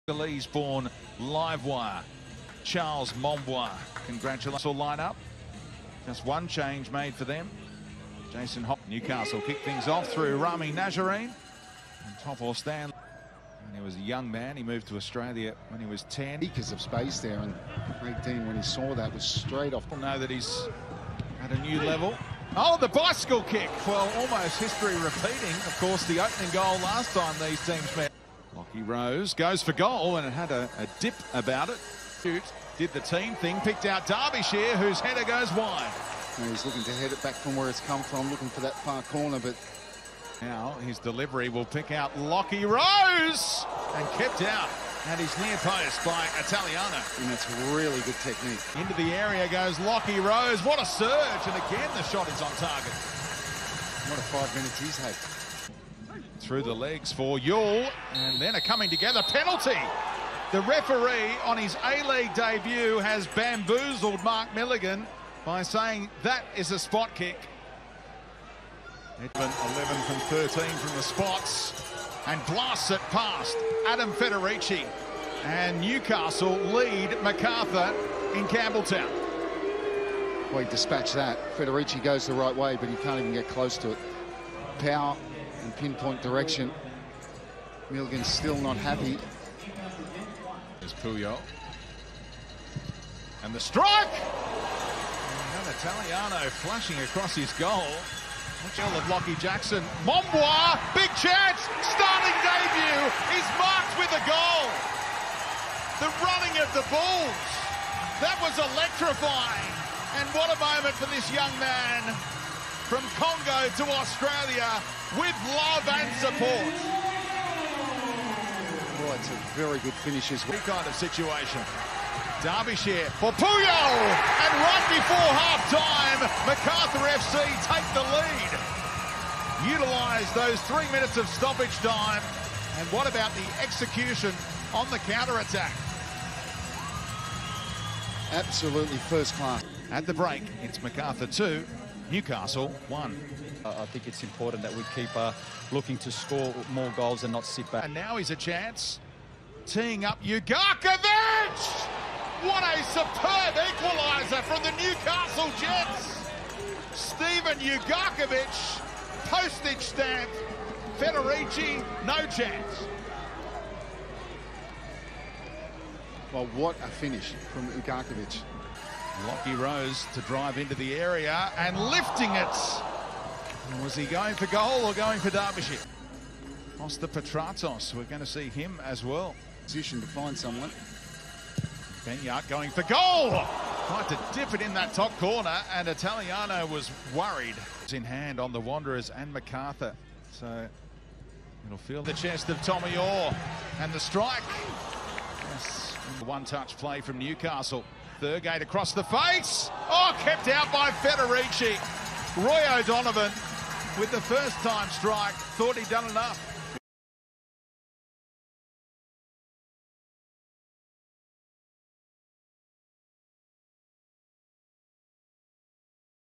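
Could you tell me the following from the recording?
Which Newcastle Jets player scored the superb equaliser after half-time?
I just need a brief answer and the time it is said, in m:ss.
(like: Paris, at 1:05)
Steven Ugarkovic, at 2:36.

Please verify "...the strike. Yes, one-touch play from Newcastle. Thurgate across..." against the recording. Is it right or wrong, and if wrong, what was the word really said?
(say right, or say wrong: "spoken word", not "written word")
right.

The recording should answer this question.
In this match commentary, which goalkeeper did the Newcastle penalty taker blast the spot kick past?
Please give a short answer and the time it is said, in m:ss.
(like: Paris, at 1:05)
Adam Federici, at 1:13.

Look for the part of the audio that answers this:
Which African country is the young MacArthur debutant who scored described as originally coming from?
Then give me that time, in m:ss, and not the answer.
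1:53.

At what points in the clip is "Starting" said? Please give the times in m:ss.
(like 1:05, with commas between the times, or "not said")
1:41.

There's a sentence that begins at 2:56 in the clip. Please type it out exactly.
Kosta Petratos, we're going to see him as well.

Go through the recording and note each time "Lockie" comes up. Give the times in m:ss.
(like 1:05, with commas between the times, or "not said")
0:28, 0:42, 0:49, 1:39, 2:49.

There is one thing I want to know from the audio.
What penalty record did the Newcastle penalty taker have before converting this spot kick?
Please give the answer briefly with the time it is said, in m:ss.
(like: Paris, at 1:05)
11 from 13, at 1:09.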